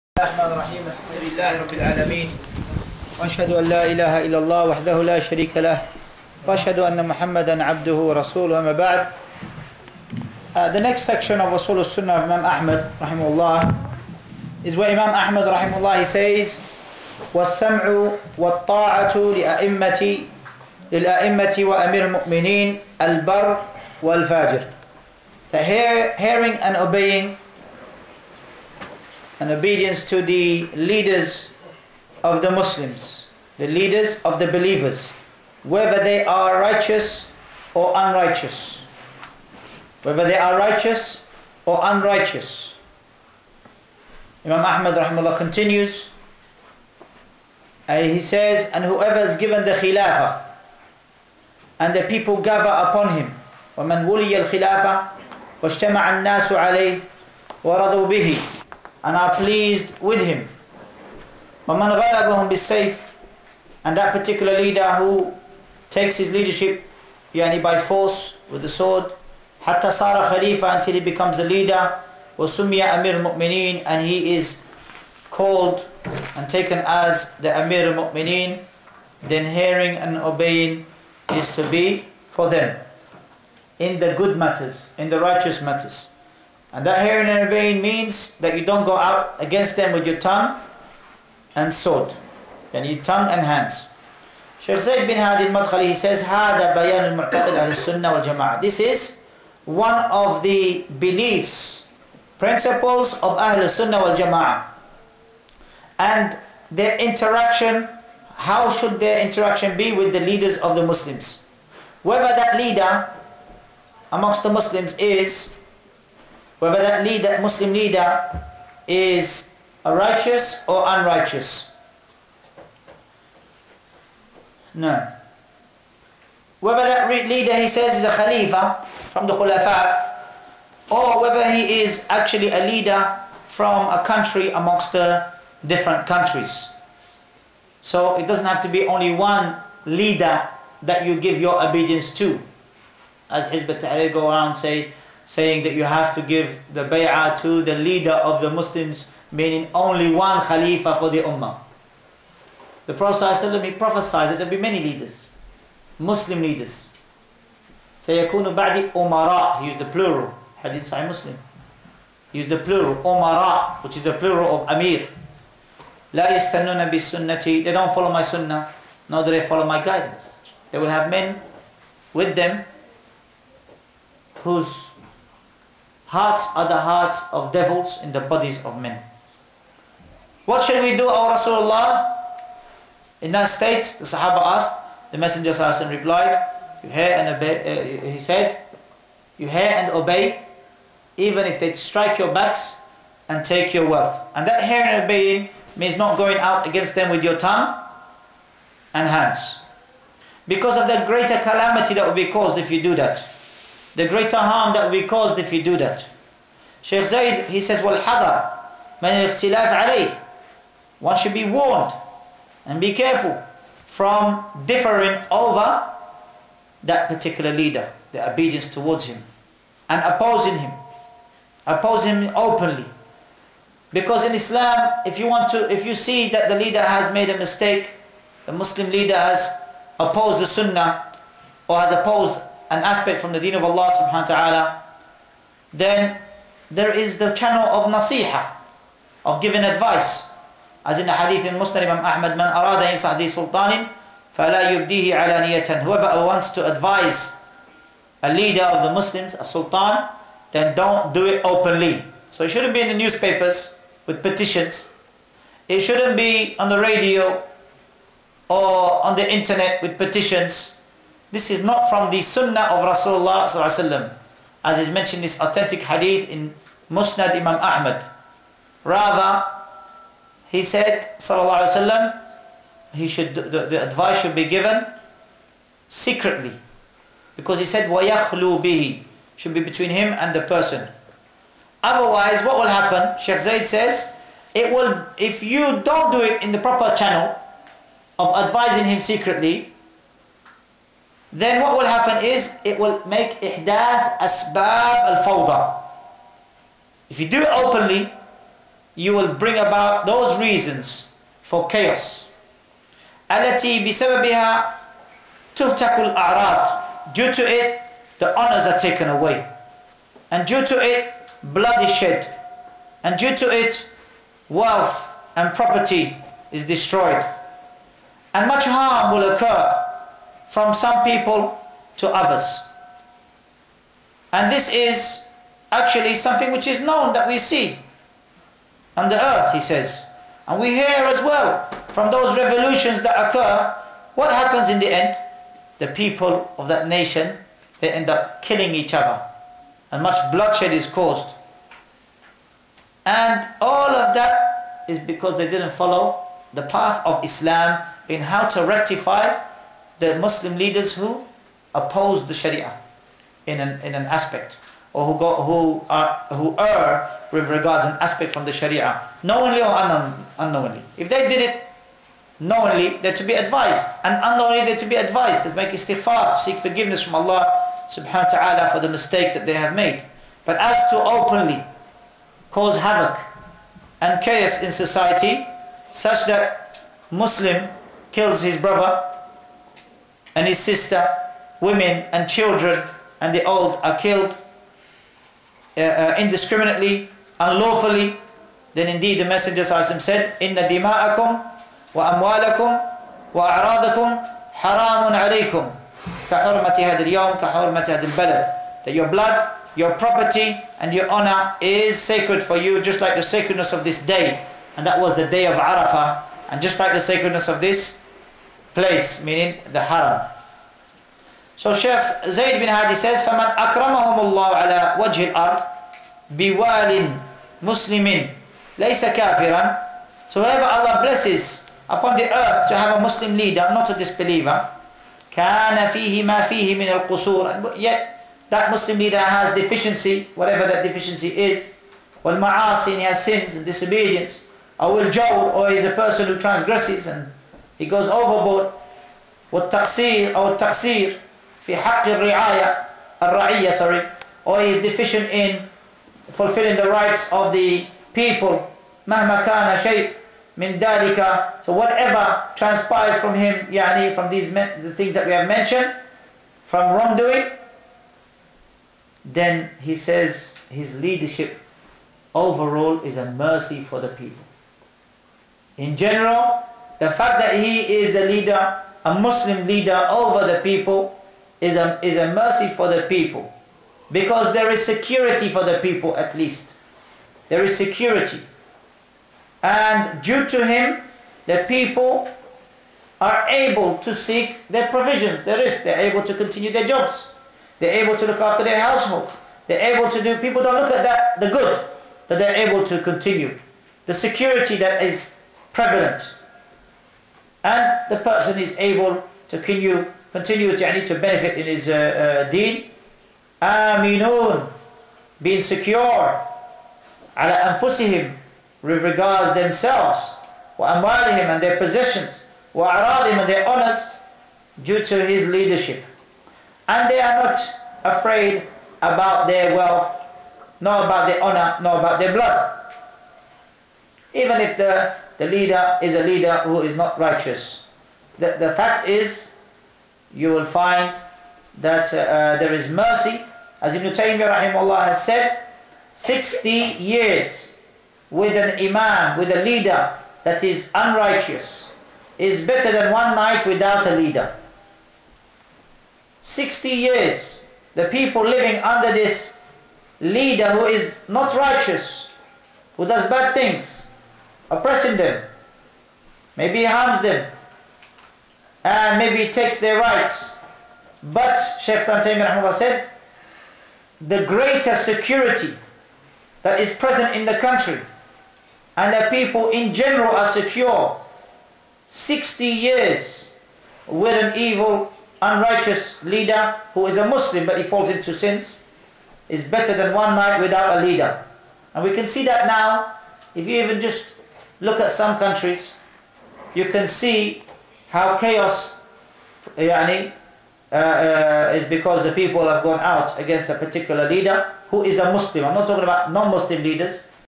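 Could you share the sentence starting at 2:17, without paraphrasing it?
So it doesn't have to be only one leader that you give your obedience to.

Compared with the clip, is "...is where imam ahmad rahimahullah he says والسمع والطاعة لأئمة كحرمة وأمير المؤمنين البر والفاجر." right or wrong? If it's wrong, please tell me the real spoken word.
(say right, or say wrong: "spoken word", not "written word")
wrong: "للأئمة", not "كحرمة".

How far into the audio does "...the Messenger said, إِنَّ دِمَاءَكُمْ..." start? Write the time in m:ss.
6:29.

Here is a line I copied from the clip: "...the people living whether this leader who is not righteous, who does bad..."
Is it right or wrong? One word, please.
wrong.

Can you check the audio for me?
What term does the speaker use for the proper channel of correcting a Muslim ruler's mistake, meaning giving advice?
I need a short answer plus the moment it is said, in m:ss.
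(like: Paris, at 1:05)
nasiha, at 3:57.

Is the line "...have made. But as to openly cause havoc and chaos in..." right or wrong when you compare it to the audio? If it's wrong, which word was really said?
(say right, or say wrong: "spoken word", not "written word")
right.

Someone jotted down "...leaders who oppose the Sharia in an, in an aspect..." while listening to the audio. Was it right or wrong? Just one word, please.
right.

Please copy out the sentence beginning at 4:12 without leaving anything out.
So it shouldn't be in the newspapers with petitions.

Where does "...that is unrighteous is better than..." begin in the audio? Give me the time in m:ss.
9:00.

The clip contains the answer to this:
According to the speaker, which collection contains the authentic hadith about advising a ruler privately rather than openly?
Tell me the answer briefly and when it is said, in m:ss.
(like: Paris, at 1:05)
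Musnad Imam Ahmad, at 4:26.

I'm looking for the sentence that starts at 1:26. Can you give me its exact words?
And that in and obeying means that you don't go out against them with your tongue and sword.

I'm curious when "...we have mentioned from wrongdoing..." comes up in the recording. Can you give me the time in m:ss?
7:35.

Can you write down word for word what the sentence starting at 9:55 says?
I'm not talking about non-Muslim leaders.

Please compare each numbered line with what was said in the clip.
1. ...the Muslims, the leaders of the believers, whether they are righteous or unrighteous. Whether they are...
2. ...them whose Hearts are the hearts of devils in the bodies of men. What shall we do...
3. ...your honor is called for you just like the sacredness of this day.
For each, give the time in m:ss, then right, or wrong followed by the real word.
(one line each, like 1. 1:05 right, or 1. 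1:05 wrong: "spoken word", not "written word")
1. 0:32 right
2. 2:52 right
3. 6:40 wrong: "sacred", not "called".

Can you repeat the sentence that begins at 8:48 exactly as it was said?
The, the fact is, you will find that uh, uh, there is mercy.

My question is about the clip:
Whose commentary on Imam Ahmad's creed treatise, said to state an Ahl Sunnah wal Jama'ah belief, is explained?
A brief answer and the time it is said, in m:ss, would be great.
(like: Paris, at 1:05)
Zayd bin Hadi al-Madkhali, at 1:34.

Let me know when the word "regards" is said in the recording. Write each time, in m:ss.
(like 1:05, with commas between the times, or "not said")
5:57, 8:29.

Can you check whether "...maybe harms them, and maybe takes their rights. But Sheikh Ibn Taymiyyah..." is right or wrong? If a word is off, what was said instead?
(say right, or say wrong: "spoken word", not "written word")
right.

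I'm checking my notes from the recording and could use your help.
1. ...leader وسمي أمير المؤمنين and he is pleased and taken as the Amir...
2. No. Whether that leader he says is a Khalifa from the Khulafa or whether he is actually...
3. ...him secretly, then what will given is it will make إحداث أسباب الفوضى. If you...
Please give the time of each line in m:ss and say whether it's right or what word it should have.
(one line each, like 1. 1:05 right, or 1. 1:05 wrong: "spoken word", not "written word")
1. 1:11 wrong: "called", not "pleased"
2. 2:04 right
3. 4:48 wrong: "happen", not "given".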